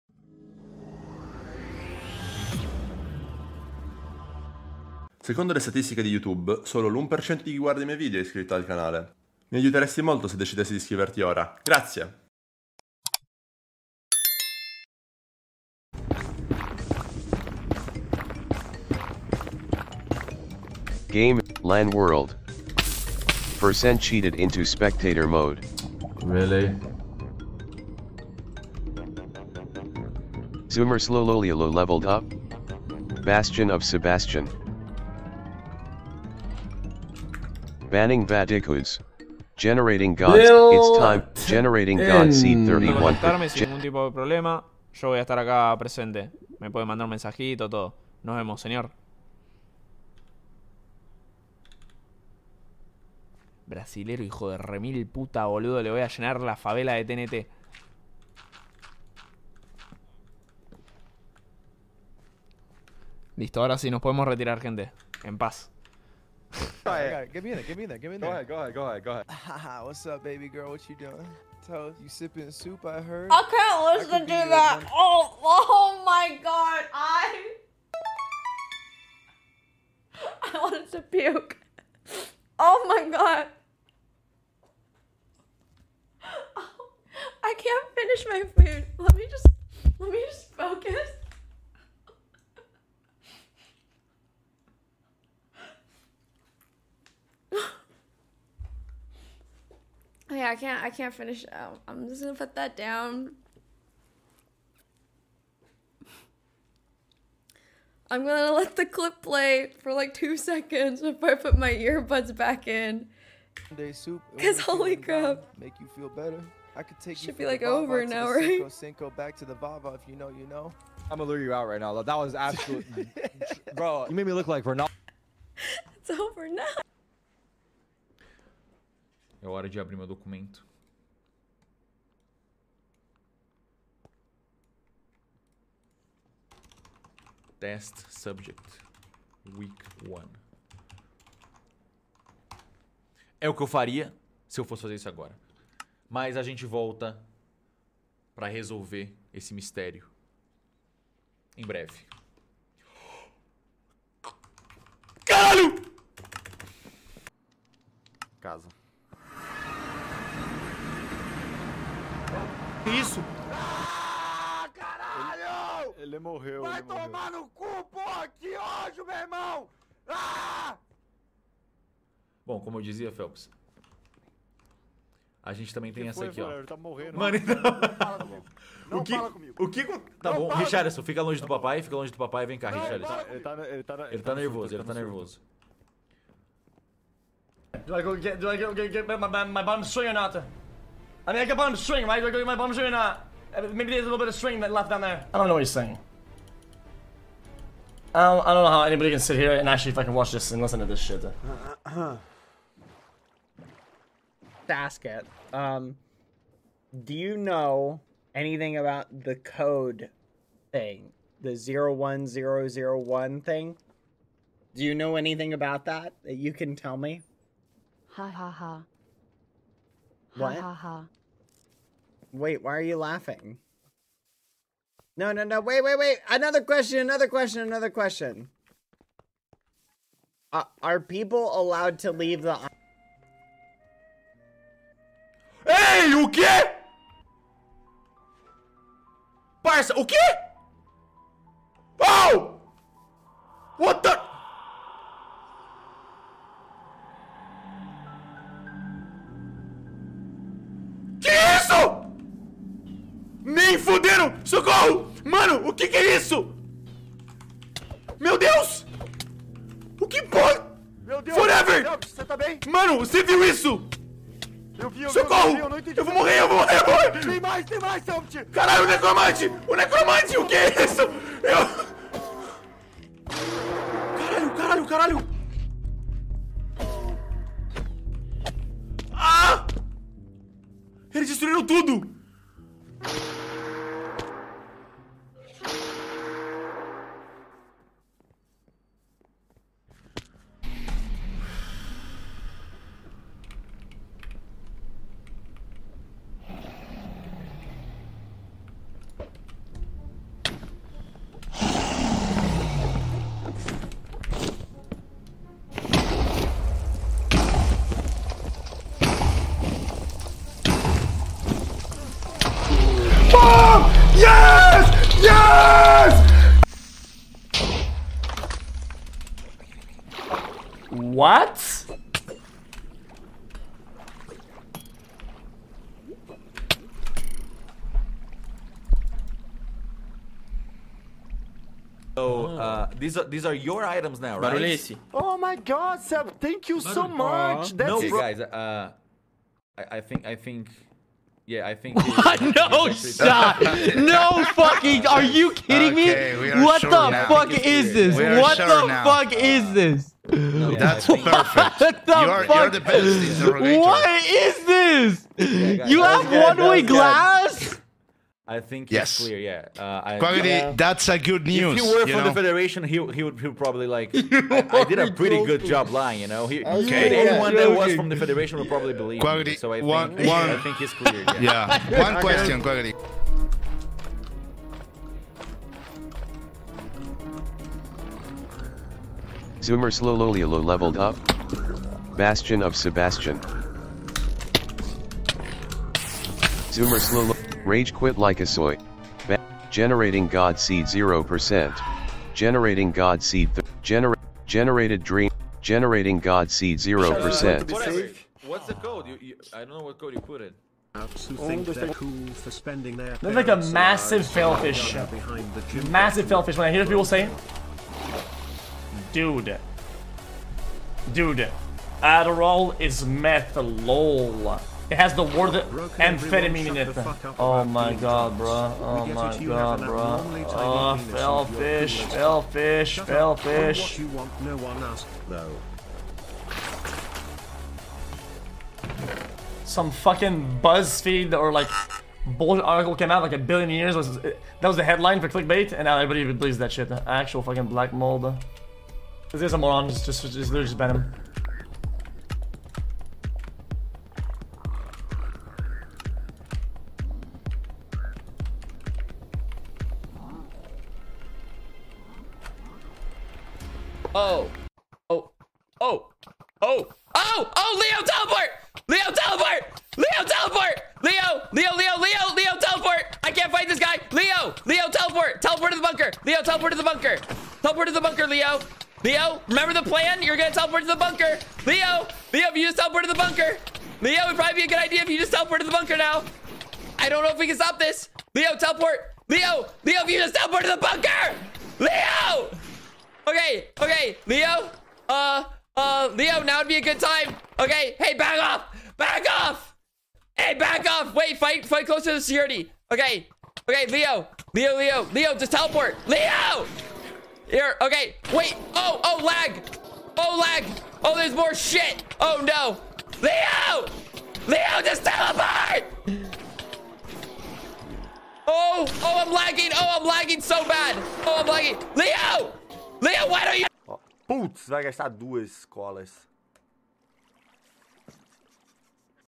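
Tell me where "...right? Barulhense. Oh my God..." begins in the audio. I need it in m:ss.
5:34.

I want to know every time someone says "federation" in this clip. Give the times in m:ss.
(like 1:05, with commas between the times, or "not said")
6:02, 6:08.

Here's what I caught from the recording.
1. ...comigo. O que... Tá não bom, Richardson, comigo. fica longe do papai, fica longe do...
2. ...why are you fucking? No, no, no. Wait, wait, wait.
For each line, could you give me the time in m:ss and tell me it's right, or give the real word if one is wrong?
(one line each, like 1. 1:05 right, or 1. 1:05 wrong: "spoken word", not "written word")
1. 2:59 right
2. 3:42 wrong: "laughing", not "fucking".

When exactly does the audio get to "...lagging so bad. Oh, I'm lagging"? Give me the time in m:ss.
8:30.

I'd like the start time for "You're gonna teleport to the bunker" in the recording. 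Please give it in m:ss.
7:50.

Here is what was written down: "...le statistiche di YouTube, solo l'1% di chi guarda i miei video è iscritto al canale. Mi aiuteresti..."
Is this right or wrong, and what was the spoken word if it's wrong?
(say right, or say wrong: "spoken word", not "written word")
right.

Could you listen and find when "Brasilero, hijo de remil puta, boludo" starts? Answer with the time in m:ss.
0:53.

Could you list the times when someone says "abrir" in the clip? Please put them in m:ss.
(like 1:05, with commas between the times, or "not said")
2:09.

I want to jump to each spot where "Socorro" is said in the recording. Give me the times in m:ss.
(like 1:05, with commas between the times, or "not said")
4:14, 4:25.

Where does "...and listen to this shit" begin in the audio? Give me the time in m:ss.
3:20.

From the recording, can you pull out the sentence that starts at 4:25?
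Vi, eu, não entendi, eu, vou morrer, eu vou morrer, eu vou morrer!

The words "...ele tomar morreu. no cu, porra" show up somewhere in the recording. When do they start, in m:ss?
2:46.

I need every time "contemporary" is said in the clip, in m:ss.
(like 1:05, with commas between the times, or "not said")
not said.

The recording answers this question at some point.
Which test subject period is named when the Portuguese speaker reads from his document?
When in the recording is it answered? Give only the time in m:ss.
2:19.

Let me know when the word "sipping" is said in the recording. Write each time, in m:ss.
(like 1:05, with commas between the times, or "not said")
1:12.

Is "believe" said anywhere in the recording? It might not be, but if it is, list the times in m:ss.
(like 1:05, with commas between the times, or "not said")
6:08, 7:16.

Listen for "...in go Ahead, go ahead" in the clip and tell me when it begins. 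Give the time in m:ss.
1:08.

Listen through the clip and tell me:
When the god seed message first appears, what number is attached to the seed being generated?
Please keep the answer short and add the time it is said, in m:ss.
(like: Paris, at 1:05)
31, at 0:42.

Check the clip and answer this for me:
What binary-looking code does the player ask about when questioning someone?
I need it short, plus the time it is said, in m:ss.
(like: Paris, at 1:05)
01001, at 3:31.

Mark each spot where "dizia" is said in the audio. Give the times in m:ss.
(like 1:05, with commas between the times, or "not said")
2:52.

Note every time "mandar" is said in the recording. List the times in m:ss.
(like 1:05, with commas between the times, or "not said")
0:46.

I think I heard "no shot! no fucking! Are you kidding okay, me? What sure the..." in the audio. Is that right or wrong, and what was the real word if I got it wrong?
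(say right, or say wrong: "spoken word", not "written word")
right.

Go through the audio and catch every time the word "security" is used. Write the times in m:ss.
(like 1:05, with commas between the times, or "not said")
8:12.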